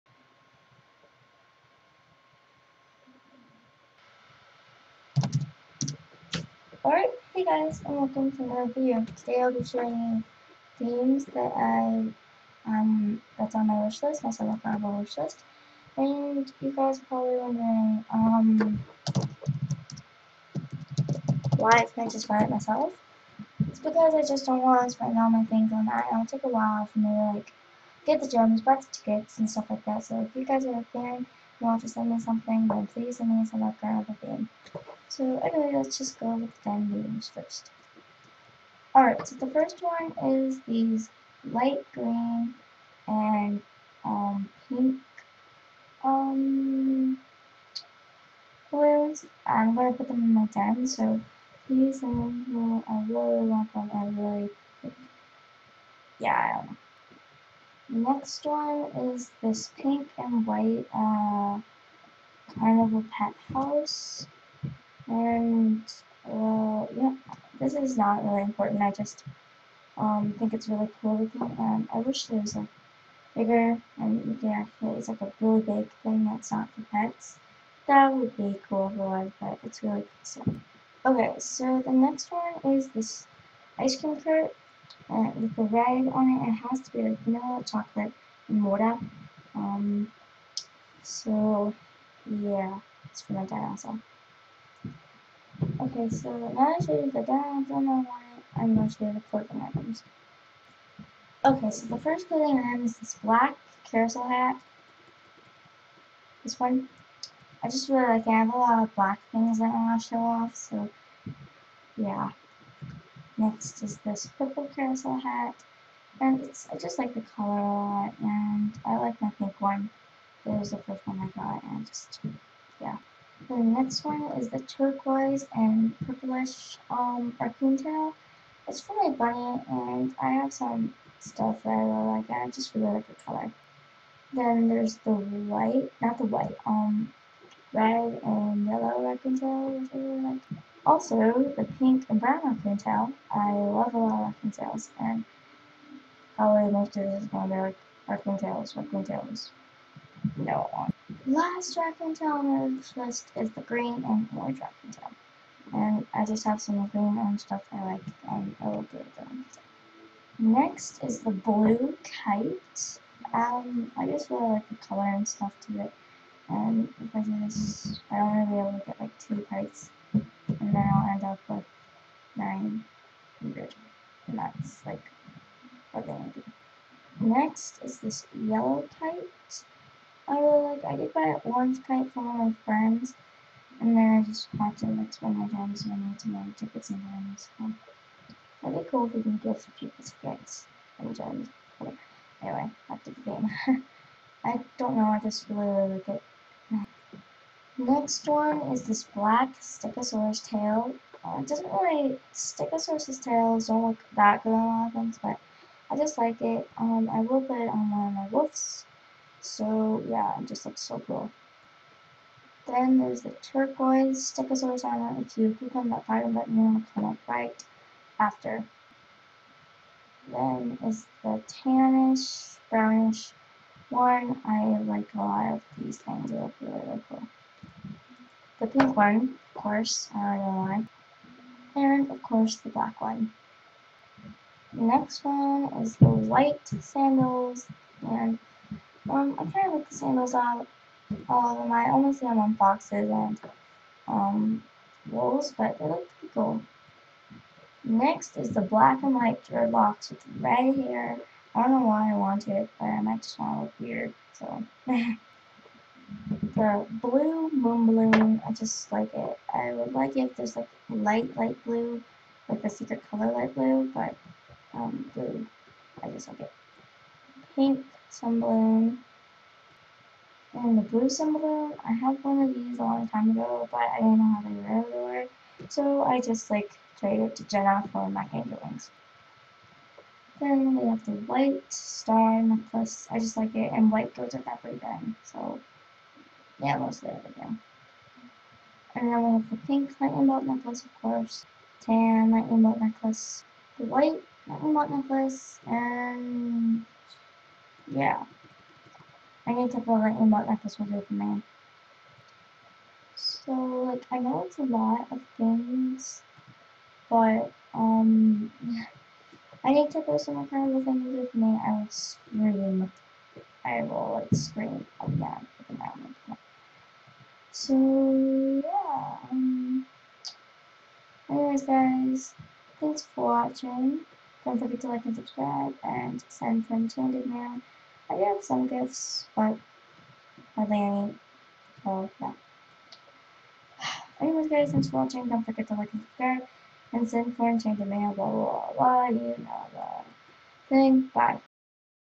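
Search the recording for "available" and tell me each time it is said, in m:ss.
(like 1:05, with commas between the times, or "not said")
not said.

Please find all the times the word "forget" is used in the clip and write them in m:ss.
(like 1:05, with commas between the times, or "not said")
5:24, 5:35.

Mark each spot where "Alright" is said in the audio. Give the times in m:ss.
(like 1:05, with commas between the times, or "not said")
0:06, 0:38.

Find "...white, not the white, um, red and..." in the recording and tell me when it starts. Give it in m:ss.
2:15.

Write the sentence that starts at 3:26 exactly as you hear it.
Um, I will put it on one of my wolf's so yeah, it just looks so cool.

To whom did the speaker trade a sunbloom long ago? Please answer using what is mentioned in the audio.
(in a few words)
Jenna.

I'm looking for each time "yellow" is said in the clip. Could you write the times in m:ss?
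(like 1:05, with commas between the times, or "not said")
2:18, 2:58.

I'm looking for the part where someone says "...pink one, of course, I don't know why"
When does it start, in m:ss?
3:48.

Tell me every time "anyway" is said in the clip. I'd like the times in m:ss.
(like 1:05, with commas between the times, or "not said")
0:35, 3:12, 5:21, 5:34.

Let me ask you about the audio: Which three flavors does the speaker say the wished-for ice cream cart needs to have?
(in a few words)
vanilla, chocolate, and water.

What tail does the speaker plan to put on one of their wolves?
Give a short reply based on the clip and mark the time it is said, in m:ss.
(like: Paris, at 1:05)
black Stegosaurus tail, at 3:19.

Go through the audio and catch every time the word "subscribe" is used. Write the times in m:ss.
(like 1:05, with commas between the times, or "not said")
5:25, 5:36.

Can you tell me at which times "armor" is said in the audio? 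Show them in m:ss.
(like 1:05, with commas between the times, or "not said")
3:34.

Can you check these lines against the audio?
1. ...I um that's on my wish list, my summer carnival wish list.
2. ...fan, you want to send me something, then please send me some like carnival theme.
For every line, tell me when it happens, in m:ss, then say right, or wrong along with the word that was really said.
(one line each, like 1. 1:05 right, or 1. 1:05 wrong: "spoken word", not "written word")
1. 0:11 right
2. 0:30 right.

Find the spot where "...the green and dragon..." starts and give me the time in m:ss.
2:33.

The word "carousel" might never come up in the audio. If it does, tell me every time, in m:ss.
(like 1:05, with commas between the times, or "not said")
1:43, 1:54.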